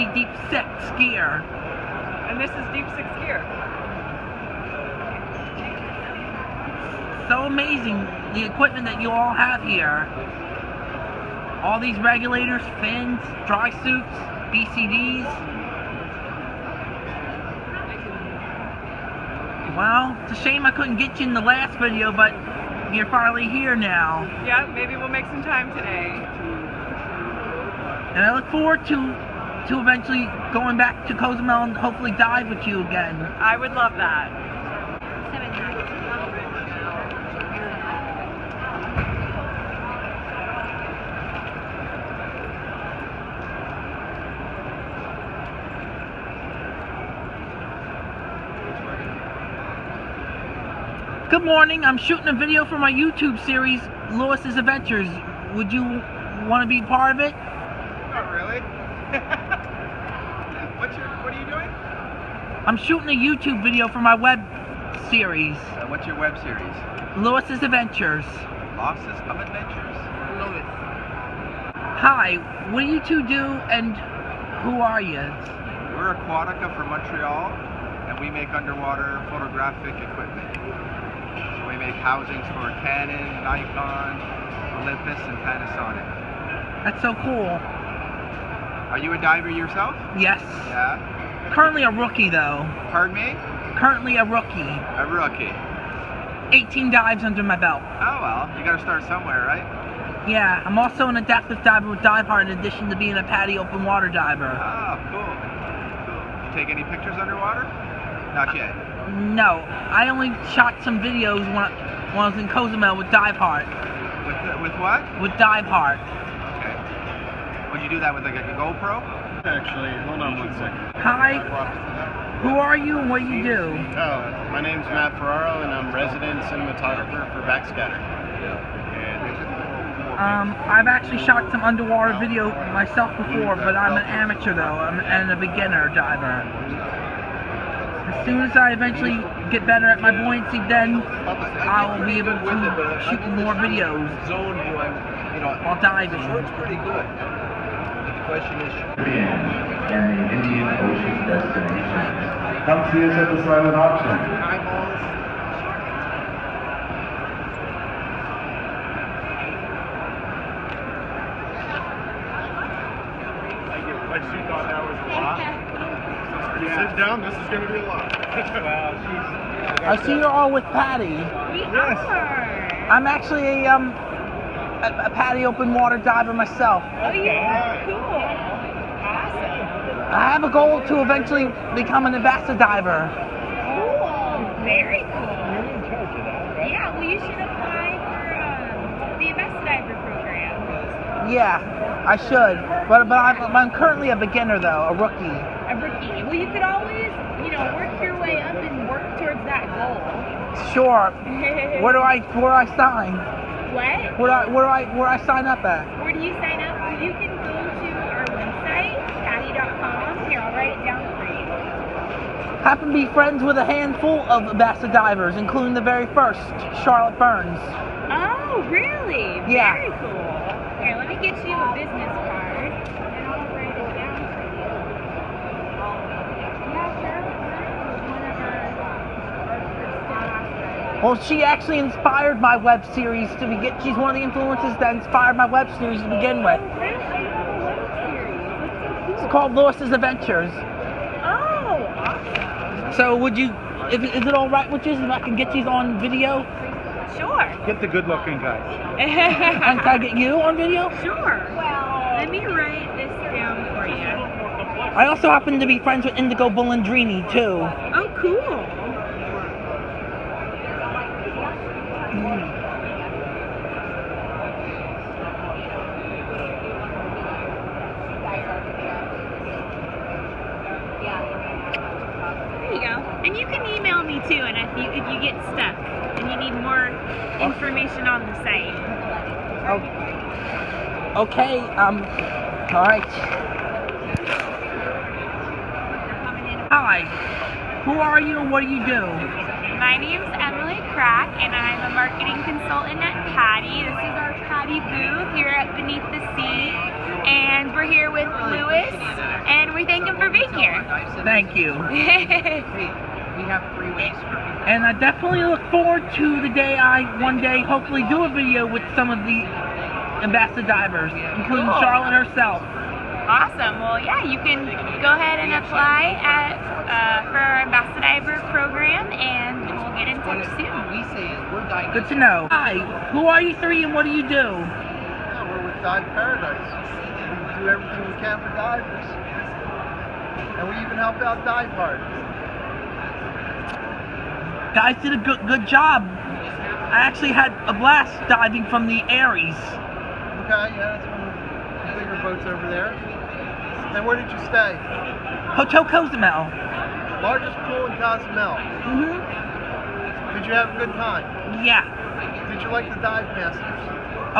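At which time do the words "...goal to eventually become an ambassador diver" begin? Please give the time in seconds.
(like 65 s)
180 s.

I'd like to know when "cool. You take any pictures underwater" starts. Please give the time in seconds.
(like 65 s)
105 s.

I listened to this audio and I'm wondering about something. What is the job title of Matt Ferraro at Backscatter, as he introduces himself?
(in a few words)
Resident cinematographer.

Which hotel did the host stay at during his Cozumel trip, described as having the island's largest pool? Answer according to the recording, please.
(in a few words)
Hotel Cozumel.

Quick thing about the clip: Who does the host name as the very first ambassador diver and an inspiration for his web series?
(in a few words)
Charlotte Burns.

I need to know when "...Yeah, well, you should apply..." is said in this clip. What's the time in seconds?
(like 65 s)
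186 s.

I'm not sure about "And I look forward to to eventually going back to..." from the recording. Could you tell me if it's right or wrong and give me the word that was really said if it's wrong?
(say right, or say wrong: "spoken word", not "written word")
right.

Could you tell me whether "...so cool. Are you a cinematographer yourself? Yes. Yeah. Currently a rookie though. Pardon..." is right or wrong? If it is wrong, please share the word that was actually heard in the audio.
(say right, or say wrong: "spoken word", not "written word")
wrong: "diver", not "cinematographer".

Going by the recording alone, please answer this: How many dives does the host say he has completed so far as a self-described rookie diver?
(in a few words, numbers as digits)
18.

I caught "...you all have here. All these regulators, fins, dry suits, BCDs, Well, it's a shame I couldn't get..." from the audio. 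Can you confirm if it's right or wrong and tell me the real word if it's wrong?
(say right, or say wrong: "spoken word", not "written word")
right.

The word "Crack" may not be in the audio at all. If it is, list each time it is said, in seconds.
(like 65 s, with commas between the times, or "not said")
290 s.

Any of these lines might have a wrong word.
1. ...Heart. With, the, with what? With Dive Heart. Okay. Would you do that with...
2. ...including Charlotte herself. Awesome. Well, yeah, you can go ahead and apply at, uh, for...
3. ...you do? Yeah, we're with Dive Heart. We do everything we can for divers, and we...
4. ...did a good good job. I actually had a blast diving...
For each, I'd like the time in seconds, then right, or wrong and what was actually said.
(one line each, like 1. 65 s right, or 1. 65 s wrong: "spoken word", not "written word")
1. 113 s right
2. 311 s right
3. 324 s wrong: "Paradise", not "Heart"
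4. 335 s right.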